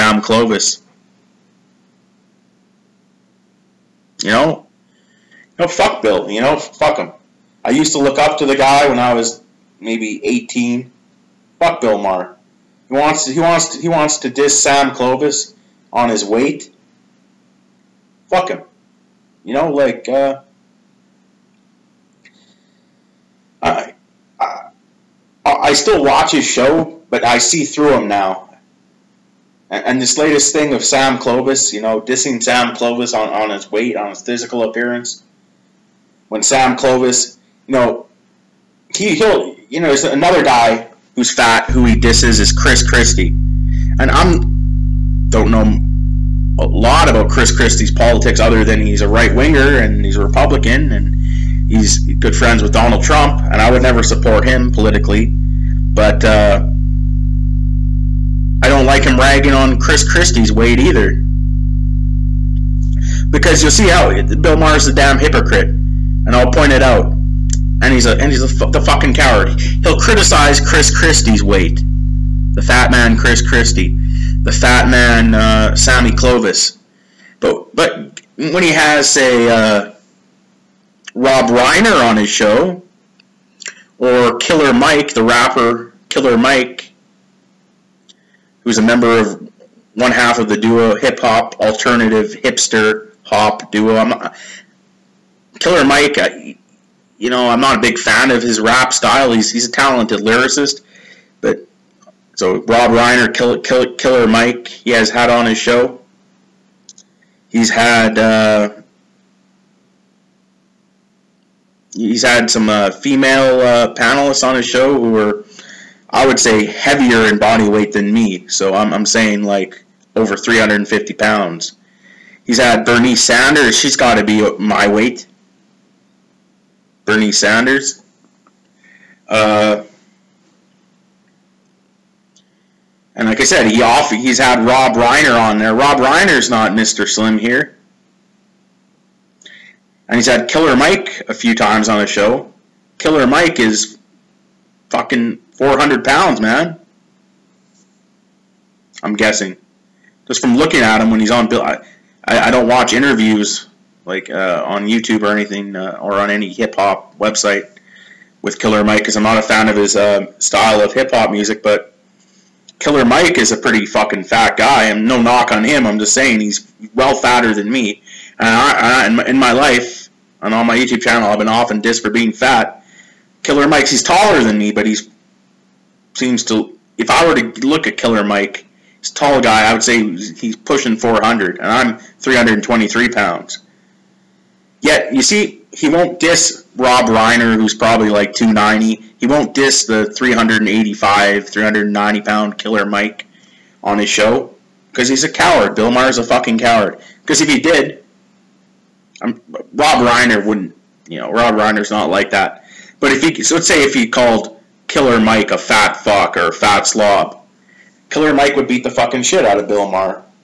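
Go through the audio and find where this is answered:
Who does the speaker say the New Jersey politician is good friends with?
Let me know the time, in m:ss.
0:52.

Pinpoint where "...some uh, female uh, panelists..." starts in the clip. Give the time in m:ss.
1:52.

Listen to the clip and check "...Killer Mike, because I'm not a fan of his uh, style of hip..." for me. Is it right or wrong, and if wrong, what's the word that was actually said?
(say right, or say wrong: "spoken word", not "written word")
right.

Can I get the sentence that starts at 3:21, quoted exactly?
You know, Rob Reiner's not like that.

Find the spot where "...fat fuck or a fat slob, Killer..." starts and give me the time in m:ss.
3:25.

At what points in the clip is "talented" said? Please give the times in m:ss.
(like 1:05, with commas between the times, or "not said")
1:39.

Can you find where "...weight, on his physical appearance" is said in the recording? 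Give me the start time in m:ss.
0:33.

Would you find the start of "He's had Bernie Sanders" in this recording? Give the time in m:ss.
2:02.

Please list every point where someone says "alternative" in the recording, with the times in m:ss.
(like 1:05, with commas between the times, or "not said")
1:31.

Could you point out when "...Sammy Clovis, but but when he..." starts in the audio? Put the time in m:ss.
1:15.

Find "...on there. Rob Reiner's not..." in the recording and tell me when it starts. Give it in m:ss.
2:15.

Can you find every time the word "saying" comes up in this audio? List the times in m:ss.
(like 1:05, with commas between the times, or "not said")
1:59, 2:46.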